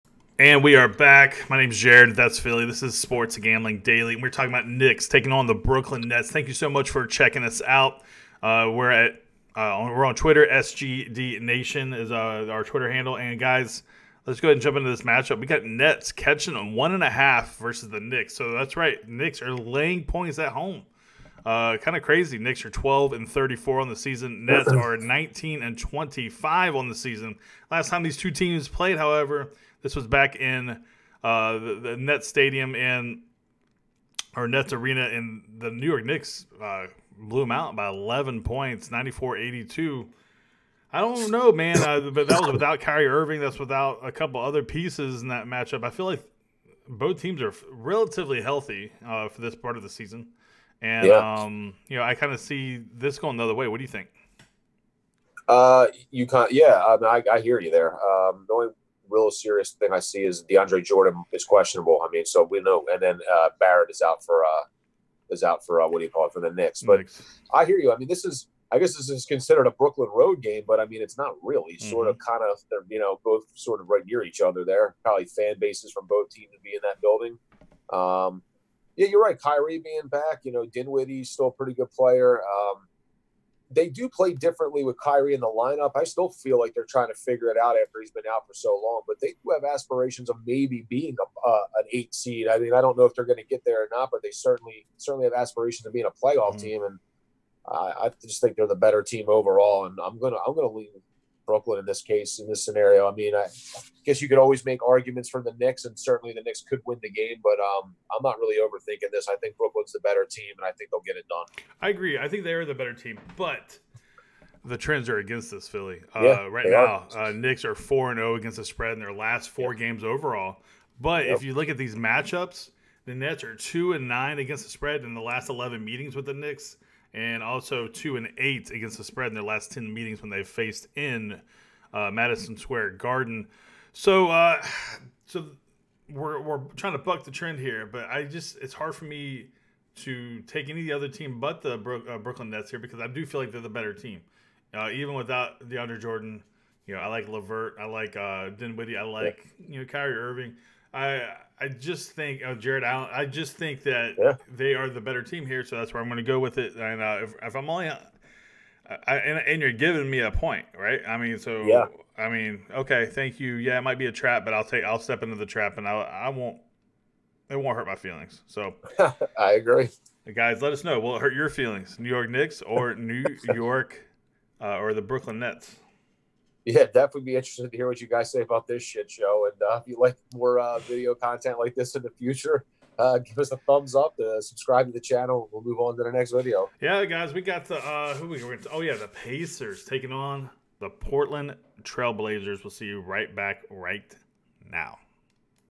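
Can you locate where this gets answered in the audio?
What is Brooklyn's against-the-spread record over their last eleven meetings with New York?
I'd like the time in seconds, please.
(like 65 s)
123 s.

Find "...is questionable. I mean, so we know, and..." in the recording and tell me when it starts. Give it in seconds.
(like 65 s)
61 s.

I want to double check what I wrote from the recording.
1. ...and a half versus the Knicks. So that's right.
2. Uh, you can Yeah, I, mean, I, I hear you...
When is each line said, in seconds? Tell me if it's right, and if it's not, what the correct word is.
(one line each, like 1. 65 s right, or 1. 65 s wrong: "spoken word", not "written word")
1. 16 s right
2. 55 s right.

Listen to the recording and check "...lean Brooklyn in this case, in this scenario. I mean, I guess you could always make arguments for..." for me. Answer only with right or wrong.
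right.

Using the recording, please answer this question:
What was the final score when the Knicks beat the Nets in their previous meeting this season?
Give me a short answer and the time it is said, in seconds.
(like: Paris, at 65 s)
94-82, at 38 s.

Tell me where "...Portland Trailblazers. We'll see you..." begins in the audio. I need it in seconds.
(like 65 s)
190 s.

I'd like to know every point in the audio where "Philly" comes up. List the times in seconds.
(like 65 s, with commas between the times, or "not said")
2 s, 115 s.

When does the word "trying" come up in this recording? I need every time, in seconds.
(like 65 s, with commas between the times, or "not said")
86 s, 136 s.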